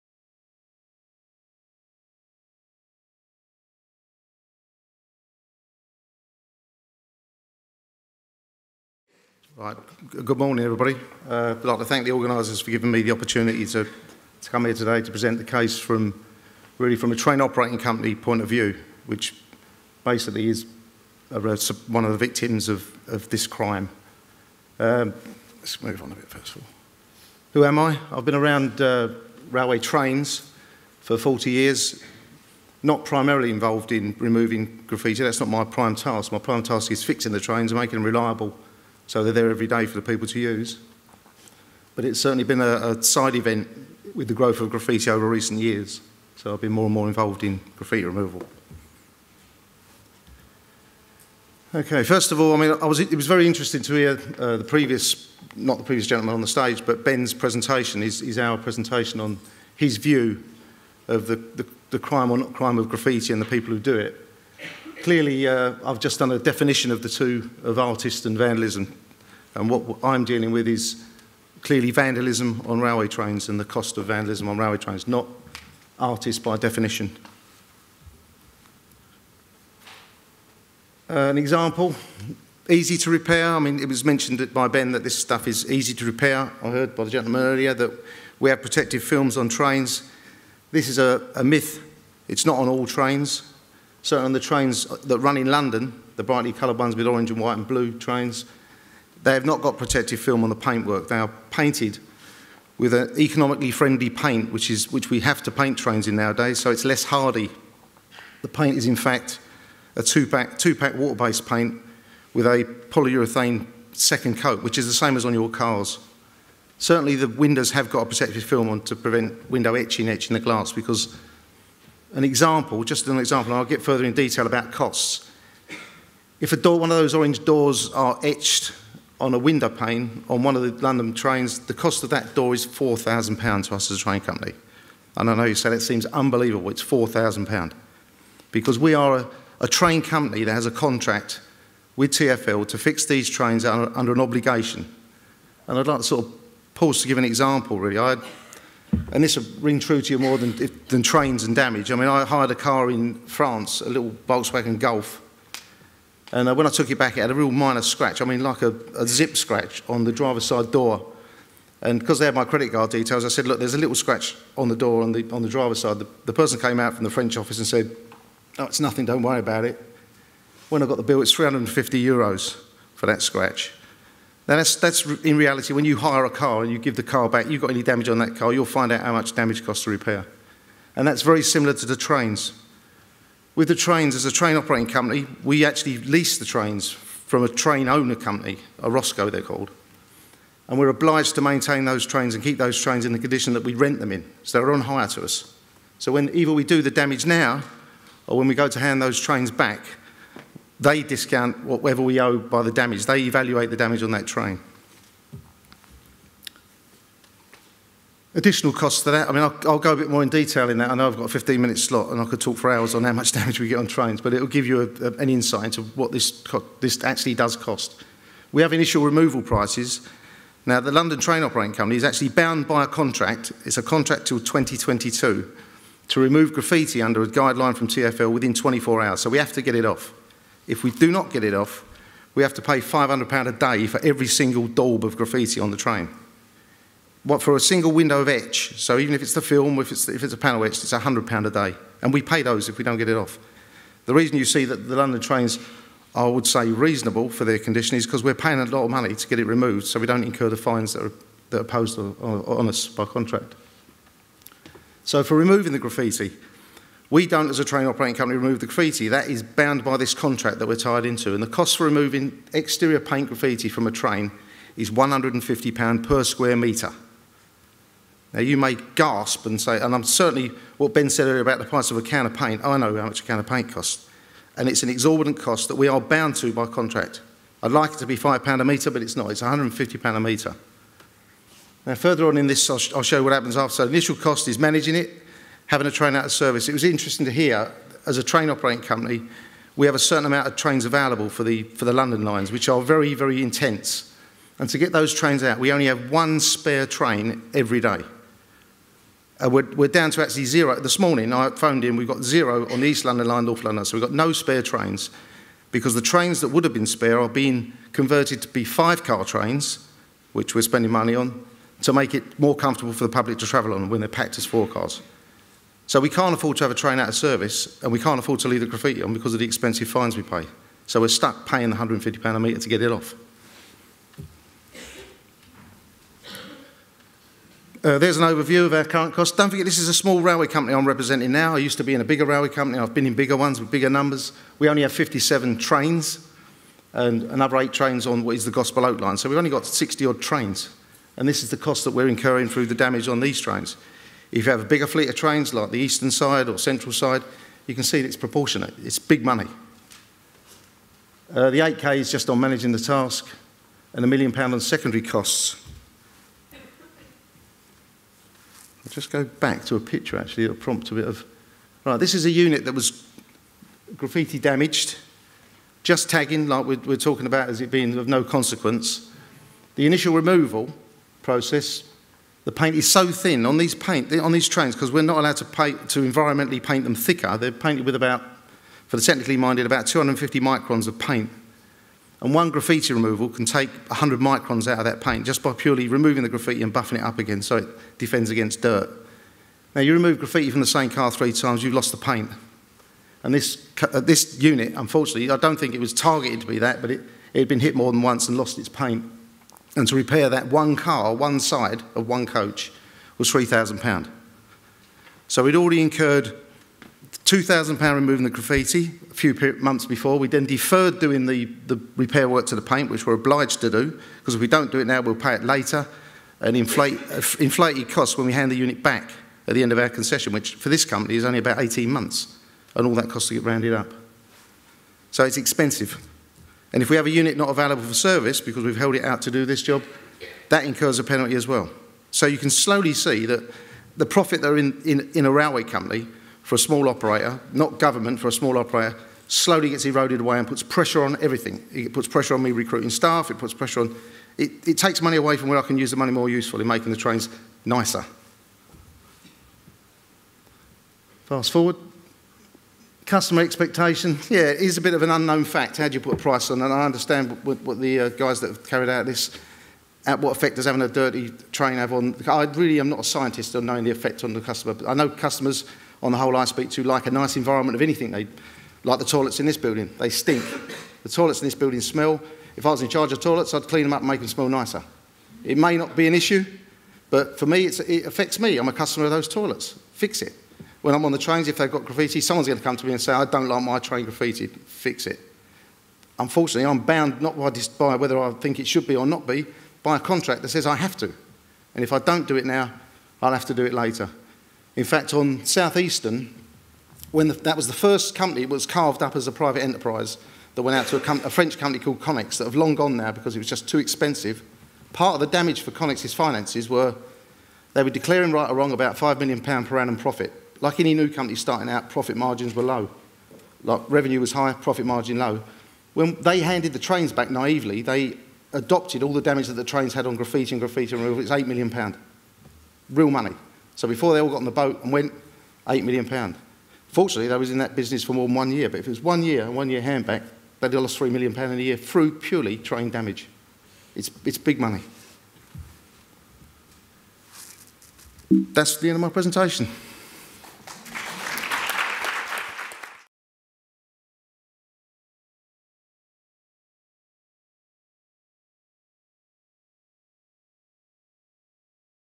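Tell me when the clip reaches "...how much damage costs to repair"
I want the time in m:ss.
2:59.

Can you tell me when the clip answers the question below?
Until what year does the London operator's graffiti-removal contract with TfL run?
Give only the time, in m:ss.
3:44.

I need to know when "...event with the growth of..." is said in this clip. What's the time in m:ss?
0:43.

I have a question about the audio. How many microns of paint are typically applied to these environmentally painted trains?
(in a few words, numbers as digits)
250 microns.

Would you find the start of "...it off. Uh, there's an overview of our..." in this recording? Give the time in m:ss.
5:22.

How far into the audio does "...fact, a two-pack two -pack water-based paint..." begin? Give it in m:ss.
1:48.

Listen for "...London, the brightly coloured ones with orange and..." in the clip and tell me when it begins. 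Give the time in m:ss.
1:35.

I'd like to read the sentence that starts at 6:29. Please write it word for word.
Now, you remove graffiti from the same car three times, you've lost the paint.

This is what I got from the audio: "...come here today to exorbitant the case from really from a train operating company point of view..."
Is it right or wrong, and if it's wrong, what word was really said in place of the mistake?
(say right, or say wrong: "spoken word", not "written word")
wrong: "present", not "exorbitant".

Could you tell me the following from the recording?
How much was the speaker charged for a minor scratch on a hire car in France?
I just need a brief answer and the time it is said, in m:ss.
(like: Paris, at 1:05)
350 euros, at 2:51.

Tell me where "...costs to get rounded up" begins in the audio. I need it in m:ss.
7:03.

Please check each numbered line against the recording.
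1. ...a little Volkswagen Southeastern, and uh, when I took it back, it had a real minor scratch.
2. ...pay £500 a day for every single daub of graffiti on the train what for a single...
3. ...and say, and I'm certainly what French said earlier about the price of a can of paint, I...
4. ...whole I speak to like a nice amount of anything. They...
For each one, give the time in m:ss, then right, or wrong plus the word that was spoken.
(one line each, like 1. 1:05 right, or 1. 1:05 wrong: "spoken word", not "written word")
1. 2:33 wrong: "Golf", not "Southeastern"
2. 3:52 right
3. 4:29 wrong: "Ben", not "French"
4. 7:46 wrong: "environment", not "amount".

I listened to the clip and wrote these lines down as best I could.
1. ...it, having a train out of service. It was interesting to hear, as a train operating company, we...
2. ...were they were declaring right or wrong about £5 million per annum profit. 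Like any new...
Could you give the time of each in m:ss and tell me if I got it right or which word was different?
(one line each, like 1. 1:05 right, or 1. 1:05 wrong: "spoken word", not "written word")
1. 4:44 right
2. 8:26 right.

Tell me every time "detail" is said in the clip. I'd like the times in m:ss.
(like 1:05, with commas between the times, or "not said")
2:04, 2:42, 3:30.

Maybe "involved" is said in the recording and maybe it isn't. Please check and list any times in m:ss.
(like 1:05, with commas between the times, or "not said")
0:33, 0:47.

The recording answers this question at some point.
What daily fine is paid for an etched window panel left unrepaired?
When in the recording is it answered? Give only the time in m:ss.
4:00.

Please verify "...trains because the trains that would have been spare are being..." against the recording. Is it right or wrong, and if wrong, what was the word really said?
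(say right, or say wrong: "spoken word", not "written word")
right.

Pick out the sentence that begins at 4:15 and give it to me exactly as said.
So for removing the graffiti, we don't as a train operating company remove the graffiti.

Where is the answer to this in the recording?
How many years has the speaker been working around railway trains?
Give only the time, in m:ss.
0:31.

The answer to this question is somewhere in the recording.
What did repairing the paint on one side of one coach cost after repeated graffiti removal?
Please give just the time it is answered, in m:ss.
6:43.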